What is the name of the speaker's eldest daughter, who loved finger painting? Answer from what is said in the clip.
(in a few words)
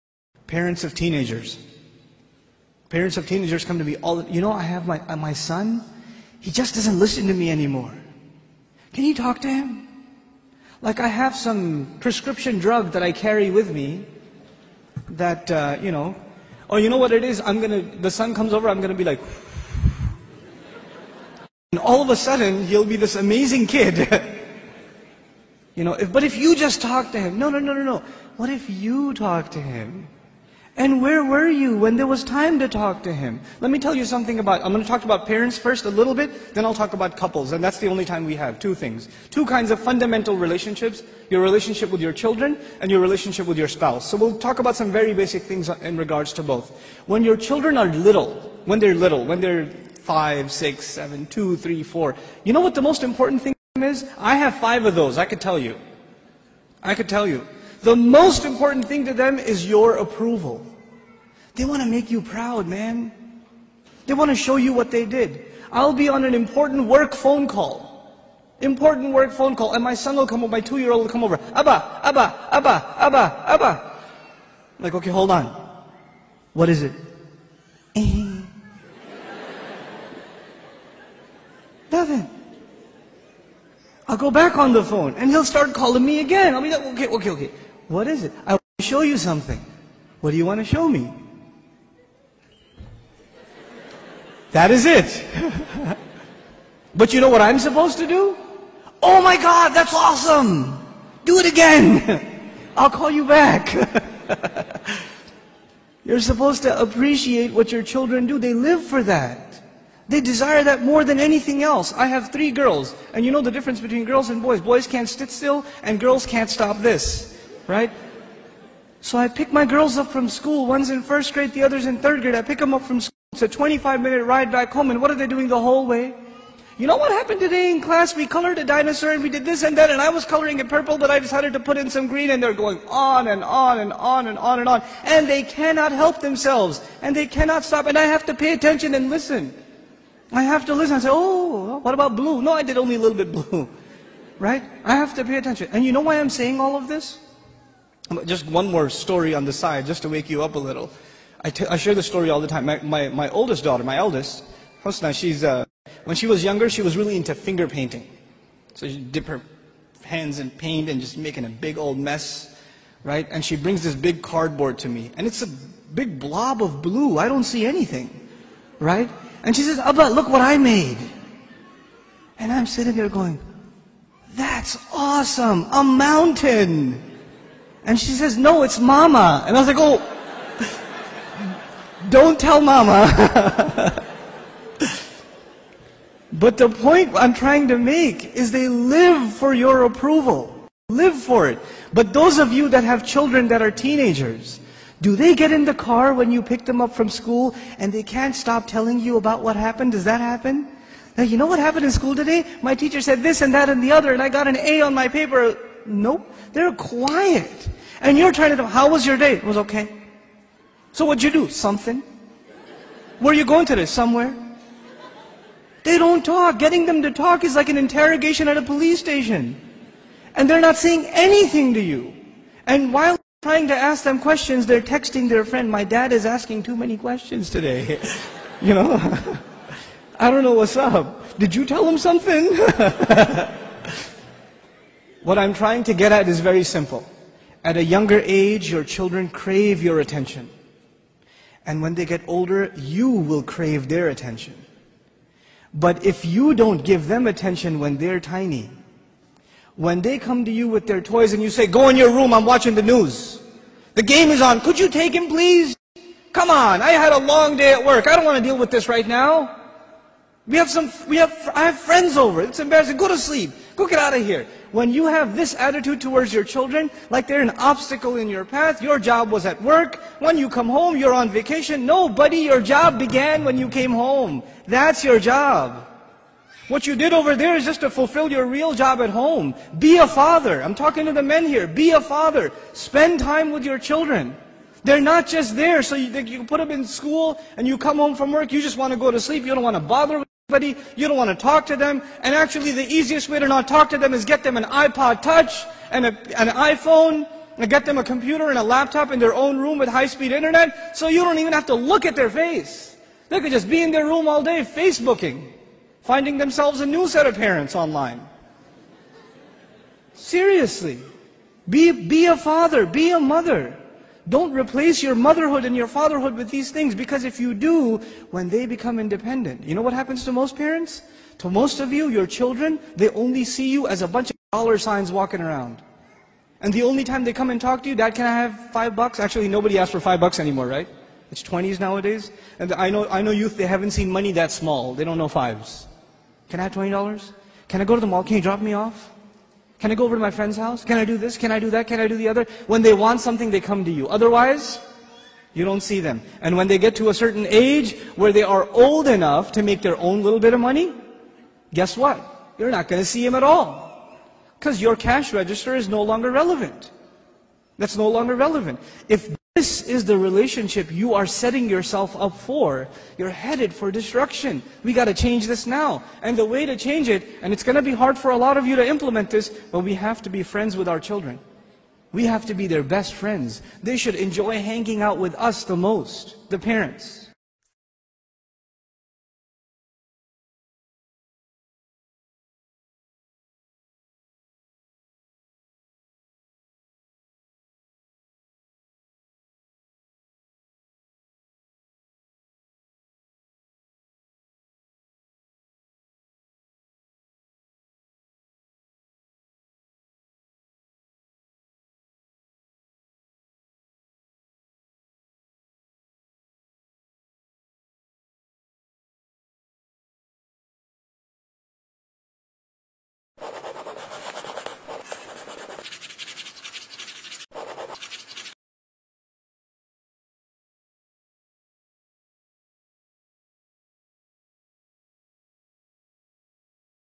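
Hosna.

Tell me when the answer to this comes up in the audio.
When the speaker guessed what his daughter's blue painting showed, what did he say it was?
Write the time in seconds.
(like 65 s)
175 s.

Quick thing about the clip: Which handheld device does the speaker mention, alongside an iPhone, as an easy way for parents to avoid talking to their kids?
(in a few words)
iPod Touch.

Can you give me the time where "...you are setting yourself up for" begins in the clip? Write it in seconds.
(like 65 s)
360 s.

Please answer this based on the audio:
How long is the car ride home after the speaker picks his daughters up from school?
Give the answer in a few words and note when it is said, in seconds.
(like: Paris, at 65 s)
25 minutes, at 123 s.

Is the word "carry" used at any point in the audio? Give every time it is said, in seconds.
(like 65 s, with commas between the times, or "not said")
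13 s.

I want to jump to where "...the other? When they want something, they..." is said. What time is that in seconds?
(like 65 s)
342 s.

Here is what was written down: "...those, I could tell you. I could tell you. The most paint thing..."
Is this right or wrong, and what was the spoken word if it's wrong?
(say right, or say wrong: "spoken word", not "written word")
wrong: "important", not "paint".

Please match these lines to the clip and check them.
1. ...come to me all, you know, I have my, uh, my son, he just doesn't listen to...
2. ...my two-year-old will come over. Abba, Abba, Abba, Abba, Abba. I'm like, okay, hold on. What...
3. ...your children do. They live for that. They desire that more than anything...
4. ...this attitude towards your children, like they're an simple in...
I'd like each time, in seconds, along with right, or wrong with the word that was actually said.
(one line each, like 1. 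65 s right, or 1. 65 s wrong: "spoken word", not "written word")
1. 3 s right
2. 70 s right
3. 107 s right
4. 265 s wrong: "obstacle", not "simple".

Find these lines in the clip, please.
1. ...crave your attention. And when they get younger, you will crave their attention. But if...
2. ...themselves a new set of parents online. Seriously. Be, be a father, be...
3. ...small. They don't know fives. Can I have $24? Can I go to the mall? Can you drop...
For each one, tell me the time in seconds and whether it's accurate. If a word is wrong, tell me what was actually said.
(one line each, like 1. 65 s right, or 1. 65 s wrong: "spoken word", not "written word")
1. 239 s wrong: "older", not "younger"
2. 306 s right
3. 334 s wrong: "20", not "24".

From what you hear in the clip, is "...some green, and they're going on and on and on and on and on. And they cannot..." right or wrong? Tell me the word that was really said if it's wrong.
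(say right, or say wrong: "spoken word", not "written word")
right.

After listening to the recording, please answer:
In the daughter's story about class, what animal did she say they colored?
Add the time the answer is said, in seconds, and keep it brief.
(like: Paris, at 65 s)
Dinosaur, at 128 s.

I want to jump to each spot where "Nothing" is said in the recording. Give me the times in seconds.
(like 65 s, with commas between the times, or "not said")
81 s.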